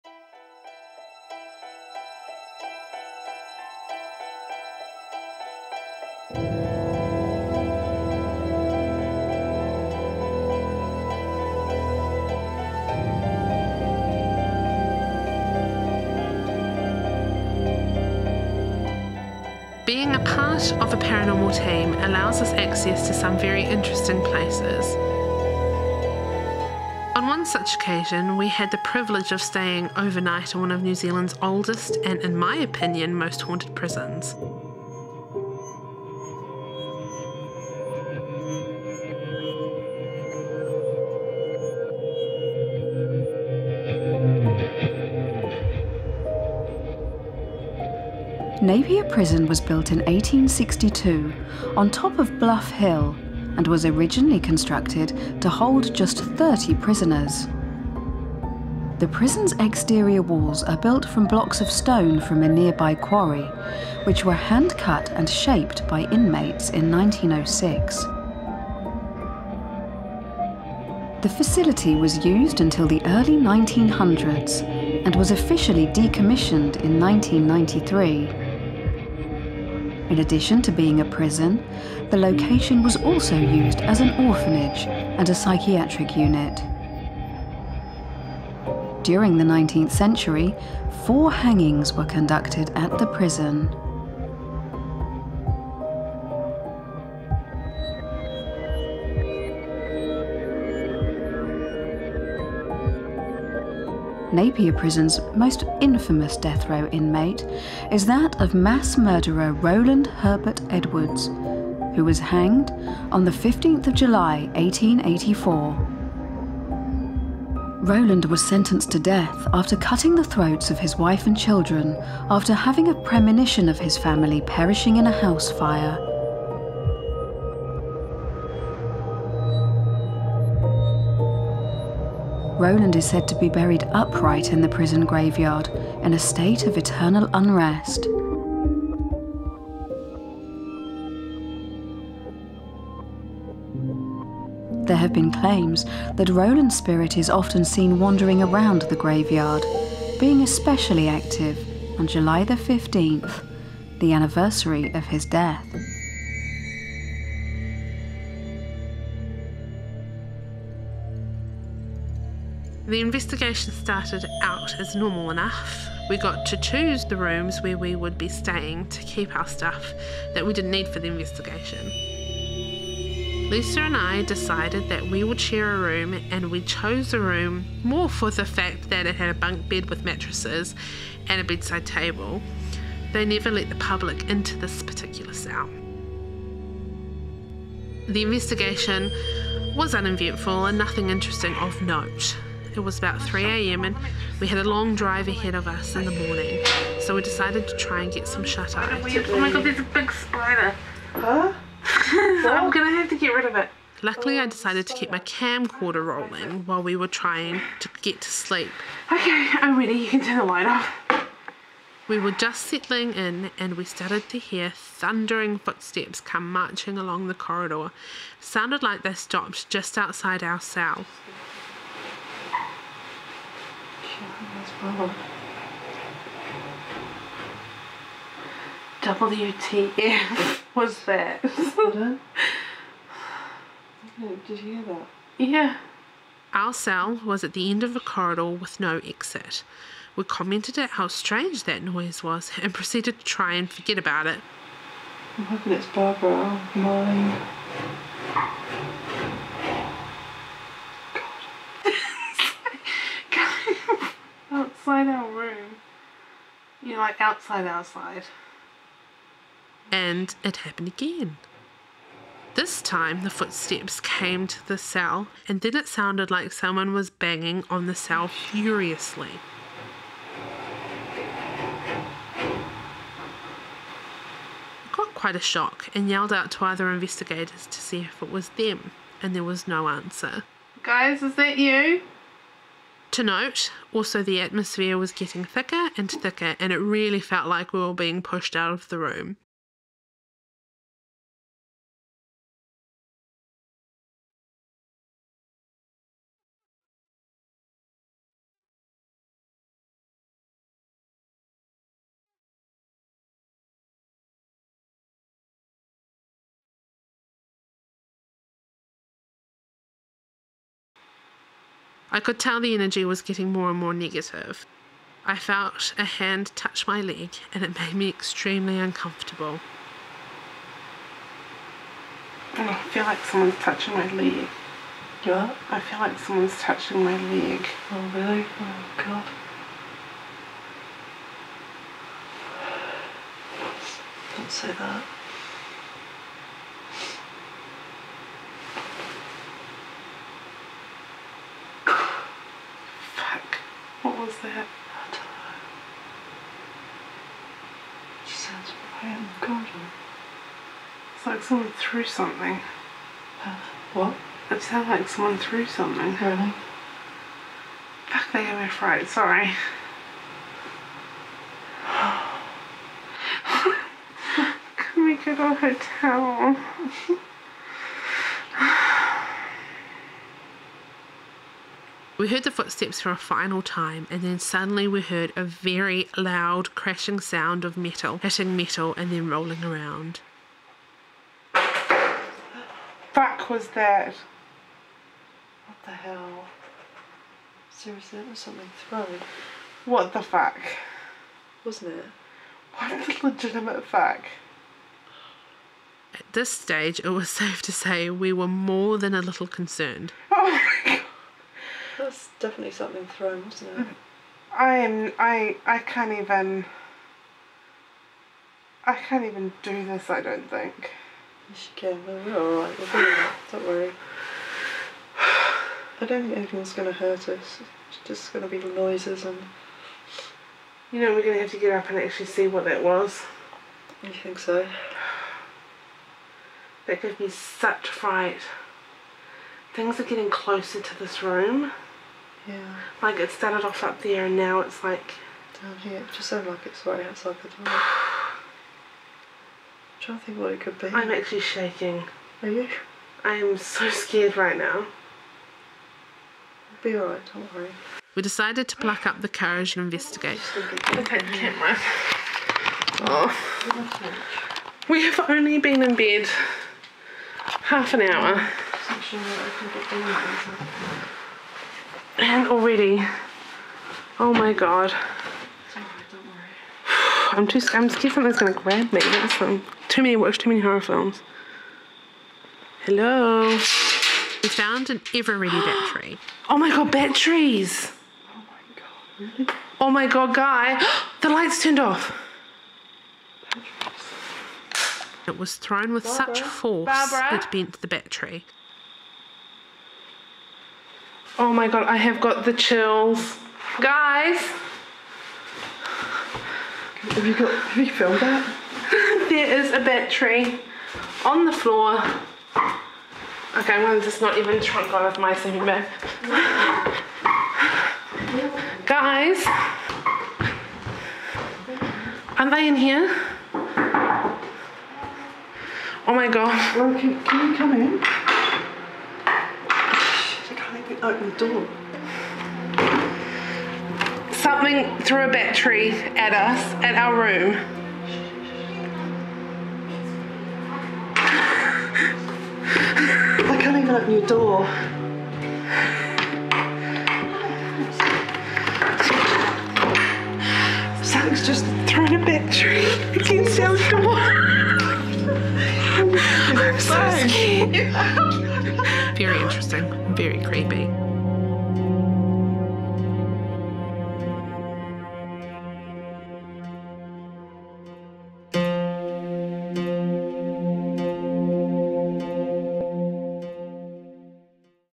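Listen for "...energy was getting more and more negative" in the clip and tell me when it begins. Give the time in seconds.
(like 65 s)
312 s.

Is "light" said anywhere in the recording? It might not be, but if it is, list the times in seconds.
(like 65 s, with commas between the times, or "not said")
210 s, 481 s.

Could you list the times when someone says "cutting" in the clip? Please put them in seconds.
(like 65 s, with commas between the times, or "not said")
119 s.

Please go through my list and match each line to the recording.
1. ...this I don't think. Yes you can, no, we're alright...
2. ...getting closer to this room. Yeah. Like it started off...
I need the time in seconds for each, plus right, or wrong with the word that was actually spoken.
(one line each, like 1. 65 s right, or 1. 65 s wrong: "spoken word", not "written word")
1. 409 s right
2. 430 s right.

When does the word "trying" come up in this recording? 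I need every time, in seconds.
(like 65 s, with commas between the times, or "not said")
207 s, 439 s.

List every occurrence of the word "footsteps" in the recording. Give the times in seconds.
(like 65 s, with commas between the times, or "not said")
215 s, 263 s, 372 s.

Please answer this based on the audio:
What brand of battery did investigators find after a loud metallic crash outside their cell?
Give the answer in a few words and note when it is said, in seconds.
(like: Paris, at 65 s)
Ever Ready, at 475 s.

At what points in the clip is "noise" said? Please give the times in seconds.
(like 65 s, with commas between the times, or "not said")
241 s, 418 s.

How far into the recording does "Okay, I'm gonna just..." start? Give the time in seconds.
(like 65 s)
503 s.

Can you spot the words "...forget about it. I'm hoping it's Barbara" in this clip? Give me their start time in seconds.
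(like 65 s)
243 s.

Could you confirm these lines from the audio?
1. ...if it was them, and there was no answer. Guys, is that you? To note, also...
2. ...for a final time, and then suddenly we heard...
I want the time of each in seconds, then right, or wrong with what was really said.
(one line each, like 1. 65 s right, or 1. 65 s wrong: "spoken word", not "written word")
1. 278 s right
2. 373 s right.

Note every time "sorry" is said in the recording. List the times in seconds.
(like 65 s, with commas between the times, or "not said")
359 s.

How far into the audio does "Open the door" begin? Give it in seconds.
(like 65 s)
521 s.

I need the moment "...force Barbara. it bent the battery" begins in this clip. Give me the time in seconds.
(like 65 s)
486 s.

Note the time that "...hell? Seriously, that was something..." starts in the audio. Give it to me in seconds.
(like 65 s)
385 s.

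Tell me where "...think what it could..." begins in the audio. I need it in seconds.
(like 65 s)
440 s.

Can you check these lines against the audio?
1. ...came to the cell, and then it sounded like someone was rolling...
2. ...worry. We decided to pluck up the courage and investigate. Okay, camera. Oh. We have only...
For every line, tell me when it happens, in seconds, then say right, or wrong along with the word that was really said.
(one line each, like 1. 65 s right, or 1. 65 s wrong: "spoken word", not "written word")
1. 264 s wrong: "banging", not "rolling"
2. 447 s right.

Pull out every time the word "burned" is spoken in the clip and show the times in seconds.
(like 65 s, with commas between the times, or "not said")
not said.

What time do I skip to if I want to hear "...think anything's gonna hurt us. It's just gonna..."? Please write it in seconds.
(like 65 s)
416 s.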